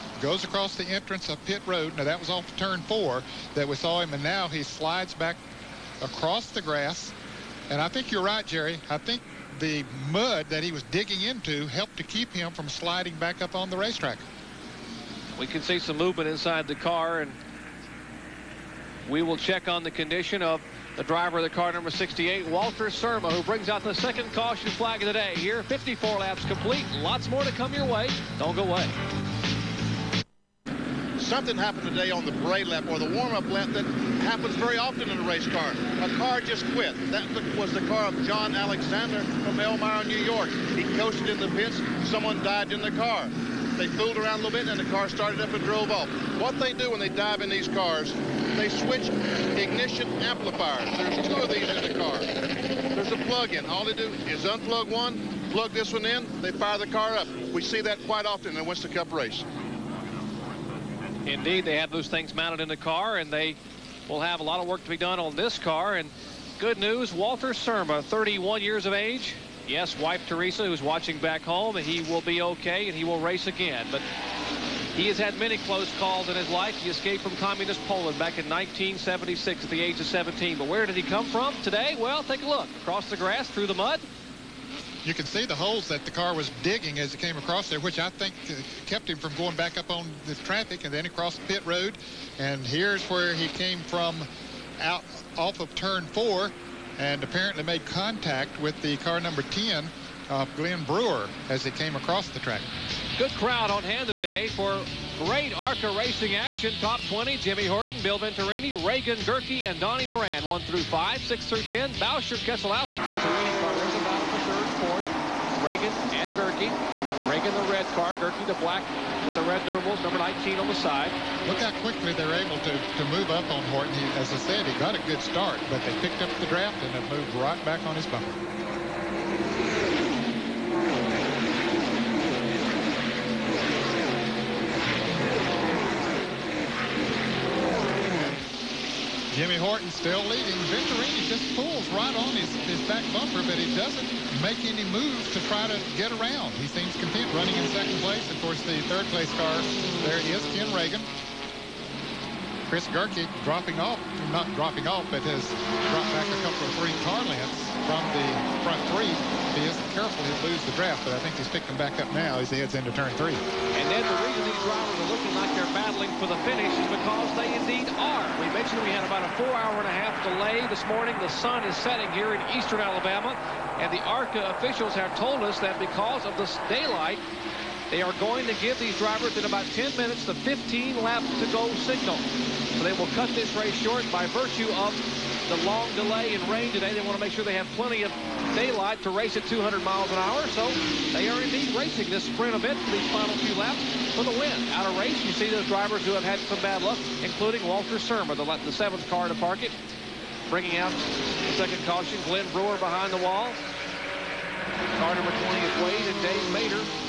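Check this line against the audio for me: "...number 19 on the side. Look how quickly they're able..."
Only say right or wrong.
right.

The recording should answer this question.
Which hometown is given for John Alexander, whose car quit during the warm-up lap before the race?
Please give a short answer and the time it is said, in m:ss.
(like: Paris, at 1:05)
Elmira, New York, at 0:39.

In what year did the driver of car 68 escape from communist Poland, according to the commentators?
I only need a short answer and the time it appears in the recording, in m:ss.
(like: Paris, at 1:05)
1976, at 1:18.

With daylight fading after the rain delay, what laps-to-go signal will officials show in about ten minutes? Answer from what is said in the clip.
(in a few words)
15 laps to go.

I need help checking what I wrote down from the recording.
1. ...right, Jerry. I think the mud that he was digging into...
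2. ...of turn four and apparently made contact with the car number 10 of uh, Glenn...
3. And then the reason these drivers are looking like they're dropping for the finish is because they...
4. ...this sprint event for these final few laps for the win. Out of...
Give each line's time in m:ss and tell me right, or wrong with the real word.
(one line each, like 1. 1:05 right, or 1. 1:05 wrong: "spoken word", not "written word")
1. 0:08 right
2. 1:35 right
3. 2:43 wrong: "battling", not "dropping"
4. 3:12 right.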